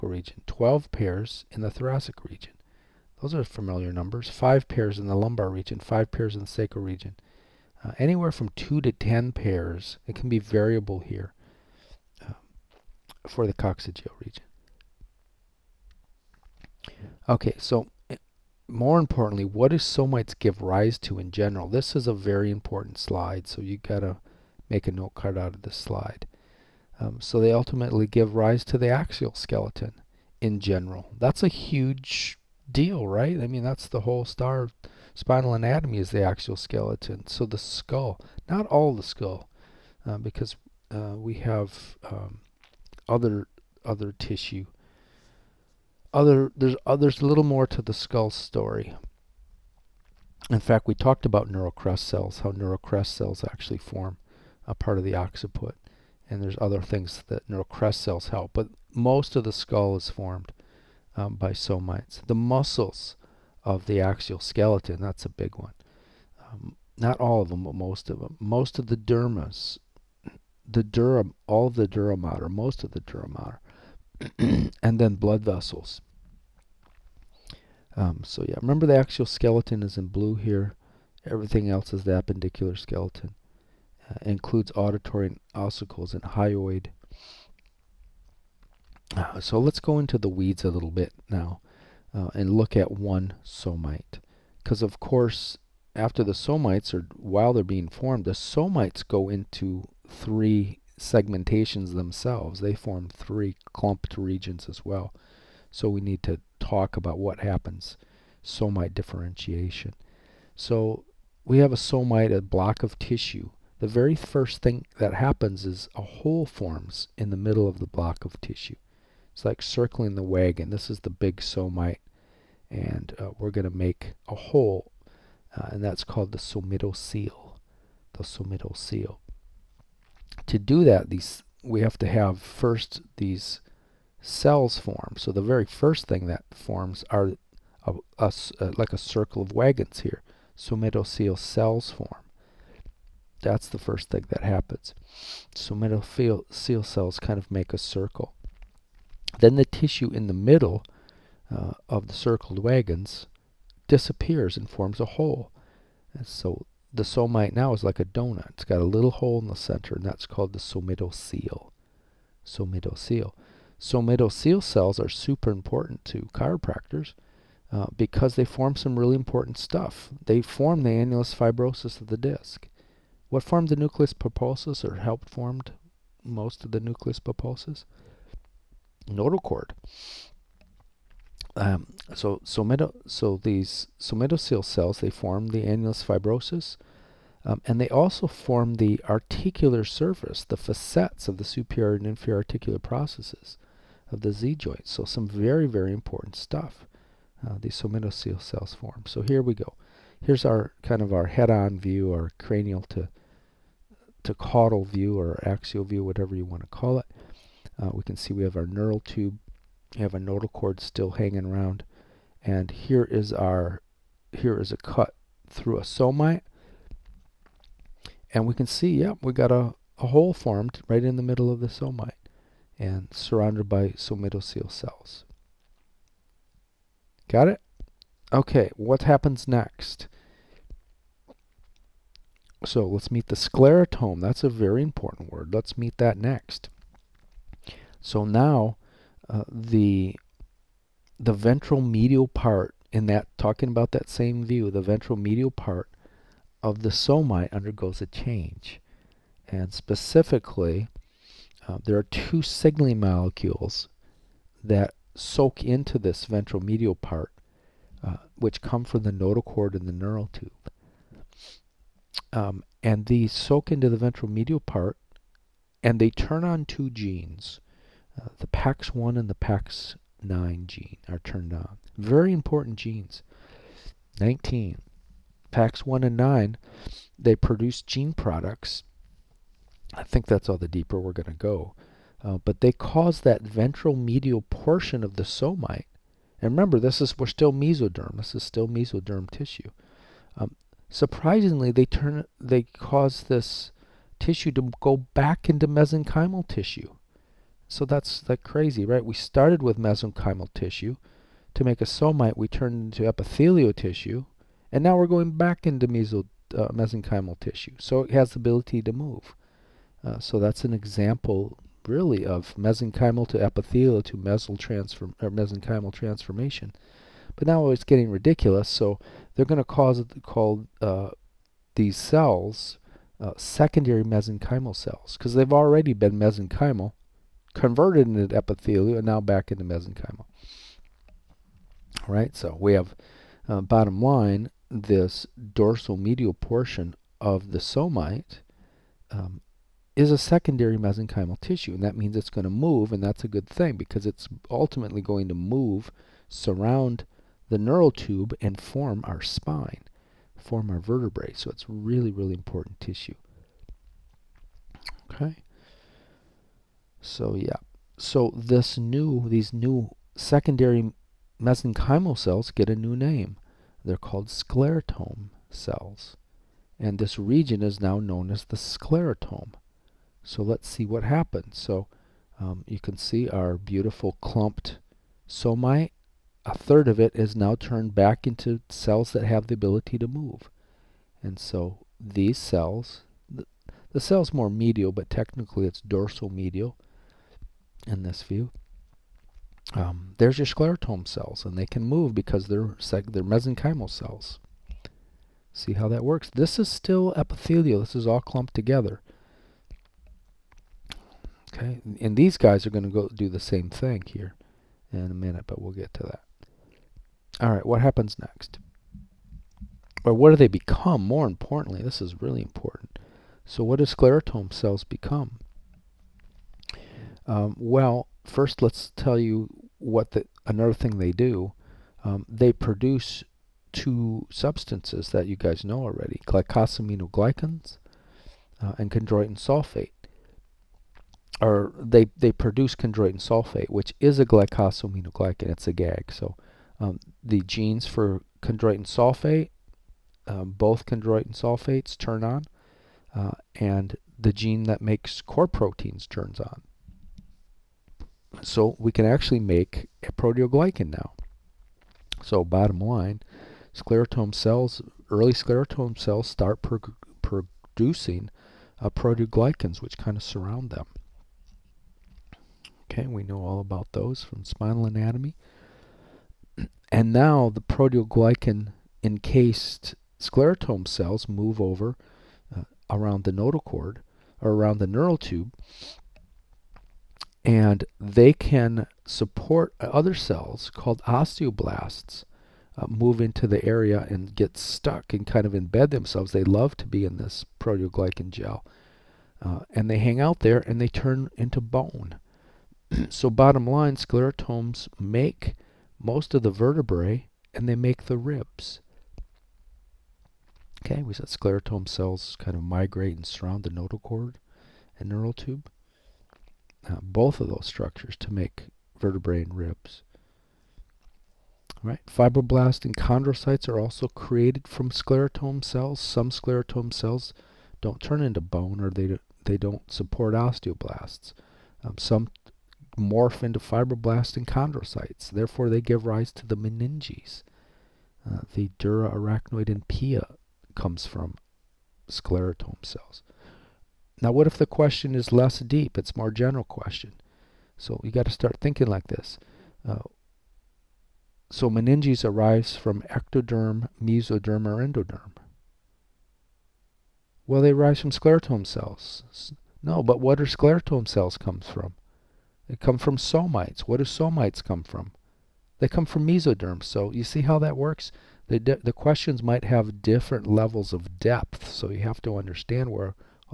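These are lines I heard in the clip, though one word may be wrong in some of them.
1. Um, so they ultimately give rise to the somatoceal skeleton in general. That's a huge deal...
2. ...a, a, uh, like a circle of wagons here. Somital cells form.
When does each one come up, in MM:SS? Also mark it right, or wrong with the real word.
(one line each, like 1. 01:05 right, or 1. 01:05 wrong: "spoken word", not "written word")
1. 00:26 wrong: "axial", not "somatoceal"
2. 02:17 right.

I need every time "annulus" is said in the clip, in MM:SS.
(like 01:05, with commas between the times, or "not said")
02:50, 03:05.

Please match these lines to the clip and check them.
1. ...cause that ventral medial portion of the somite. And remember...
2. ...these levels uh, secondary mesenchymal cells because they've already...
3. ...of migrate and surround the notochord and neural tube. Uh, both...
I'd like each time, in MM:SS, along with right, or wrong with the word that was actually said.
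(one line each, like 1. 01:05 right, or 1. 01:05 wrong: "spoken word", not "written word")
1. 04:42 right
2. 05:21 wrong: "cells", not "levels"
3. 08:22 right.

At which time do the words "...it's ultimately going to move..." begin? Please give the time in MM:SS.
05:44.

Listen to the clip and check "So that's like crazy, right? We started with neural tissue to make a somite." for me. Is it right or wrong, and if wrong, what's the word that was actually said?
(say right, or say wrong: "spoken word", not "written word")
wrong: "mesenchymal", not "neural".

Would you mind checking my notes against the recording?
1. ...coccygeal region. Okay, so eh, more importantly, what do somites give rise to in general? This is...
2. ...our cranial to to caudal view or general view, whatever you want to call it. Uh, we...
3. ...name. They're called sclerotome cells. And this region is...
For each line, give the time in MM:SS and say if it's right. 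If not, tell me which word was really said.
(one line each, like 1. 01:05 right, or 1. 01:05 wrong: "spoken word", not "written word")
1. 00:13 right
2. 03:22 wrong: "axial", not "general"
3. 06:02 right.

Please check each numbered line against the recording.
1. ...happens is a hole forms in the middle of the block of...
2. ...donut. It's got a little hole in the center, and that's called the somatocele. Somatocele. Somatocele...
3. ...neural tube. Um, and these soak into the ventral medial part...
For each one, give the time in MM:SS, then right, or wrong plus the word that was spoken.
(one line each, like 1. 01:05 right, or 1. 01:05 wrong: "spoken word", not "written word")
1. 01:55 right
2. 02:38 right
3. 04:19 right.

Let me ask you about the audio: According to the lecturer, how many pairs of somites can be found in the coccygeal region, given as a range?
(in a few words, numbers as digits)
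2 to 10.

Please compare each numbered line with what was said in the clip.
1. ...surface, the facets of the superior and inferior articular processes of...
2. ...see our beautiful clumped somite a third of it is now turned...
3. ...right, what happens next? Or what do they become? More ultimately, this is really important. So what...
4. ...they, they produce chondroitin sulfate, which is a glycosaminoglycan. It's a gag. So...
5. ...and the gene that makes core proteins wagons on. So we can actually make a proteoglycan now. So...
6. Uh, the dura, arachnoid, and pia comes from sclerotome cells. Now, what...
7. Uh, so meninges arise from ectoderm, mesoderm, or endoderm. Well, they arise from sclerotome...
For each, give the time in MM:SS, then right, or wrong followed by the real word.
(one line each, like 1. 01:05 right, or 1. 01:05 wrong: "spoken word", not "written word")
1. 03:09 right
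2. 06:12 right
3. 06:47 wrong: "importantly", not "ultimately"
4. 07:11 right
5. 07:23 wrong: "turns", not "wagons"
6. 08:48 right
7. 08:59 right.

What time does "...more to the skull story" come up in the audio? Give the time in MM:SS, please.
00:47.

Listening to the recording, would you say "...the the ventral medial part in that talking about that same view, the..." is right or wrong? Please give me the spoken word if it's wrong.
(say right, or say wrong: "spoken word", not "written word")
right.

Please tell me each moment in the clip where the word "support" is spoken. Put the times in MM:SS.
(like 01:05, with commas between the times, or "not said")
07:59, 08:39.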